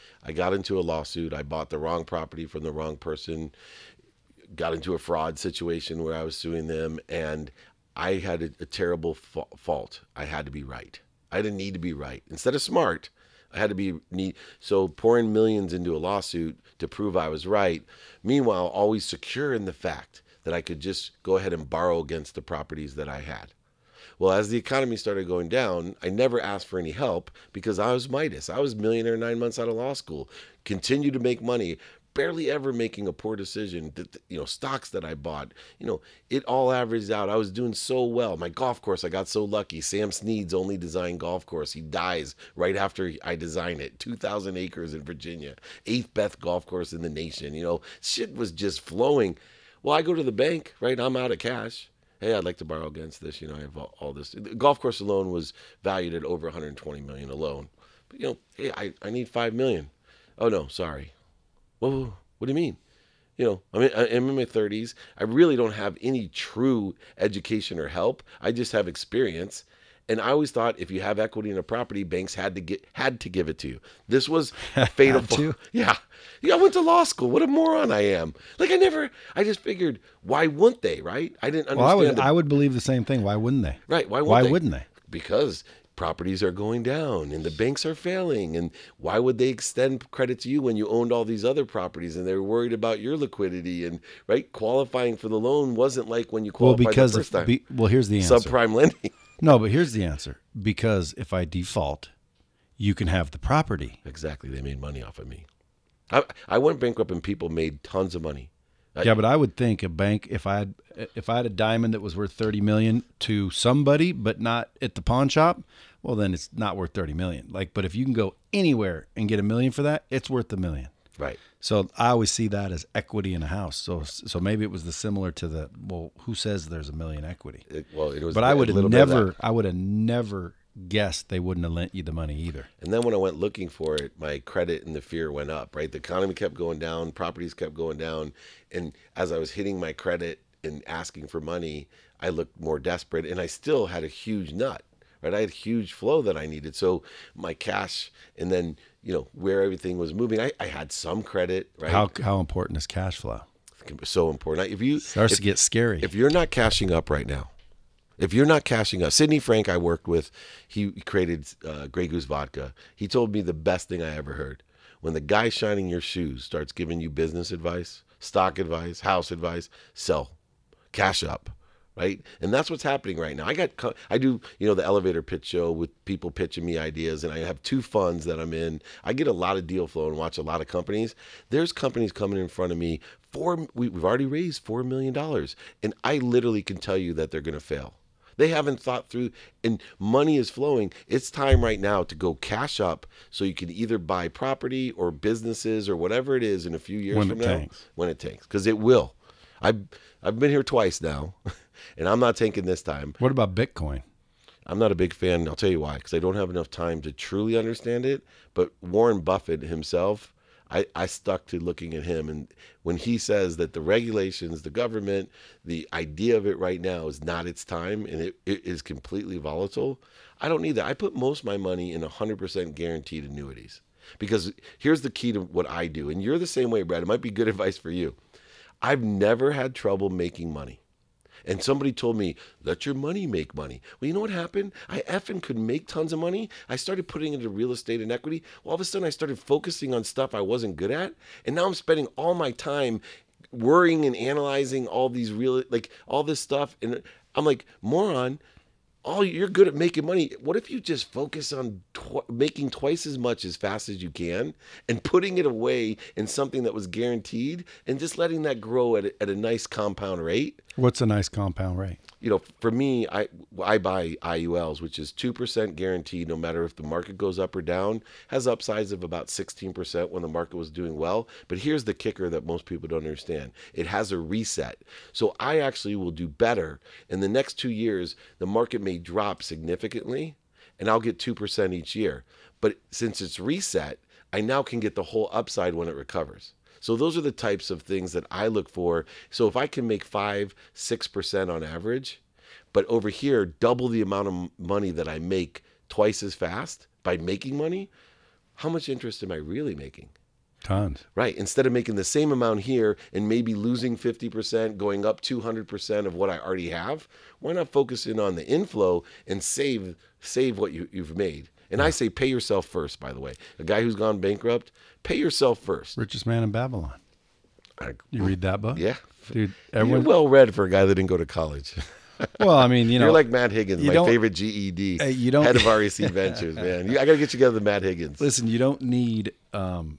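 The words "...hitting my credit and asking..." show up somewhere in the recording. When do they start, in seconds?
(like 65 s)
139 s.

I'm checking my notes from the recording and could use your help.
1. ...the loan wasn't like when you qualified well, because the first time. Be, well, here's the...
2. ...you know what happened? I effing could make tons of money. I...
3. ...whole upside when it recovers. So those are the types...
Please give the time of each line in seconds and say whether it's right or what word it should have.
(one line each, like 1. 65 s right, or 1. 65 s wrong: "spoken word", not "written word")
1. 95 s right
2. 234 s right
3. 285 s right.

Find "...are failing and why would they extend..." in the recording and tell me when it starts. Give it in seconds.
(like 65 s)
87 s.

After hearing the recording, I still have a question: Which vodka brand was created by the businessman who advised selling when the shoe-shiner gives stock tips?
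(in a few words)
Grey Goose.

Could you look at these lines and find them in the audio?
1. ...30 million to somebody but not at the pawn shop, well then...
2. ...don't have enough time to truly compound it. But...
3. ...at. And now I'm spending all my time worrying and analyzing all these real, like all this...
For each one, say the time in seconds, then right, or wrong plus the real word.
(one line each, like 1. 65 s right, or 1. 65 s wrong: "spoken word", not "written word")
1. 112 s right
2. 206 s wrong: "understand", not "compound"
3. 240 s right.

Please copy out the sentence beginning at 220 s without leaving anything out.
I put most of my money in 100% guaranteed annuities.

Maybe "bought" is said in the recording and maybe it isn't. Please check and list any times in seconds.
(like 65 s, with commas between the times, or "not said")
1 s, 35 s.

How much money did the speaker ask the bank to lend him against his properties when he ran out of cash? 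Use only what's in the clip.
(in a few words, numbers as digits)
5 million.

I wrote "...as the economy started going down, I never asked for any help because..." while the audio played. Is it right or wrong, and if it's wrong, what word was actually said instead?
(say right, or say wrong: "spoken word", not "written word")
right.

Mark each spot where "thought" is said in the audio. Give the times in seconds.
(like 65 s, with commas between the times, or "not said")
70 s, 188 s.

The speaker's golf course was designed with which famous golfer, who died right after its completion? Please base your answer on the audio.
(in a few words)
Sam Snead.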